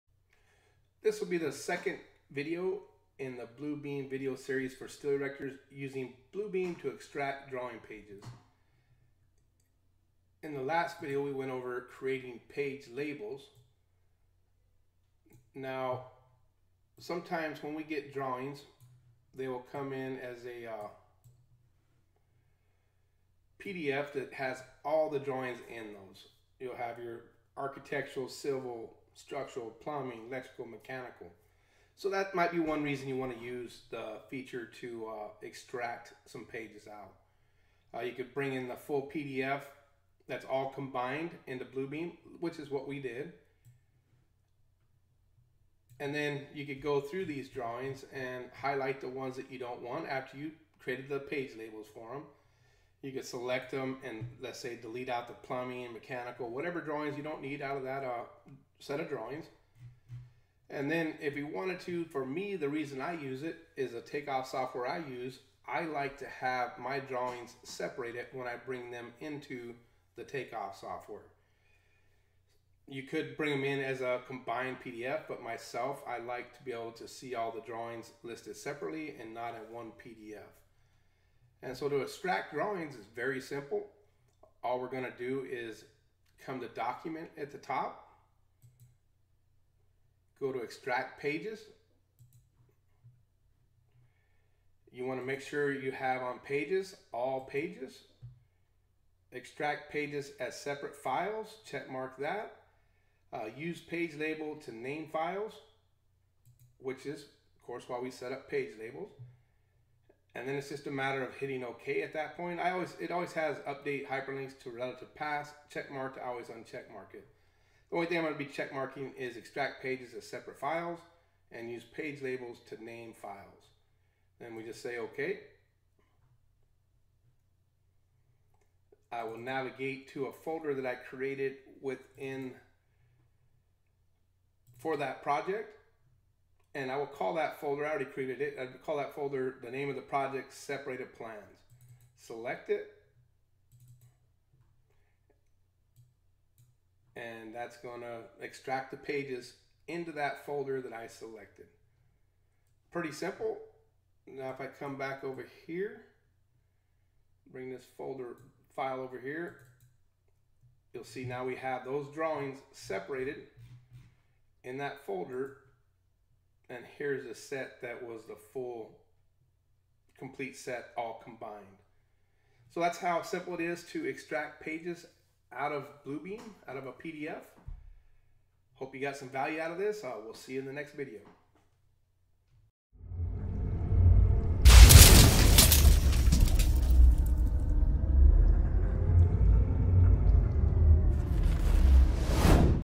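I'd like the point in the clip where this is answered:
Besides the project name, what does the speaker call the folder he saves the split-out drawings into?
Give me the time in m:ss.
2:20.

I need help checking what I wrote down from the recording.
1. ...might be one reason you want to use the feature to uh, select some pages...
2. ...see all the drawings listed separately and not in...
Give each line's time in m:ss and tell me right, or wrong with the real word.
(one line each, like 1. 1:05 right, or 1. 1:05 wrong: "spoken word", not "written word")
1. 0:32 wrong: "extract", not "select"
2. 1:17 right.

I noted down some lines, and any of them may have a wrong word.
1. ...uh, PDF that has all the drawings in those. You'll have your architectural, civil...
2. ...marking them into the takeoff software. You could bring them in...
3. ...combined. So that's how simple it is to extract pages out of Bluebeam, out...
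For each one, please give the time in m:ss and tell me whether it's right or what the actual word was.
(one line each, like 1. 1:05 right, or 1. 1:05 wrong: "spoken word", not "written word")
1. 0:20 right
2. 1:08 wrong: "bring", not "marking"
3. 2:51 right.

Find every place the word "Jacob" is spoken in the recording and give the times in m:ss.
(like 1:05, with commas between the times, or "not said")
not said.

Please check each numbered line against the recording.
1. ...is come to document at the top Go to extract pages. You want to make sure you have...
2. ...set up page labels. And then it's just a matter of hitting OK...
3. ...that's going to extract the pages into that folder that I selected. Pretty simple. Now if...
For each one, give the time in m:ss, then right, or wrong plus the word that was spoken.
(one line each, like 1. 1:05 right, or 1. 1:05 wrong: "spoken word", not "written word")
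1. 1:25 right
2. 1:48 right
3. 2:27 right.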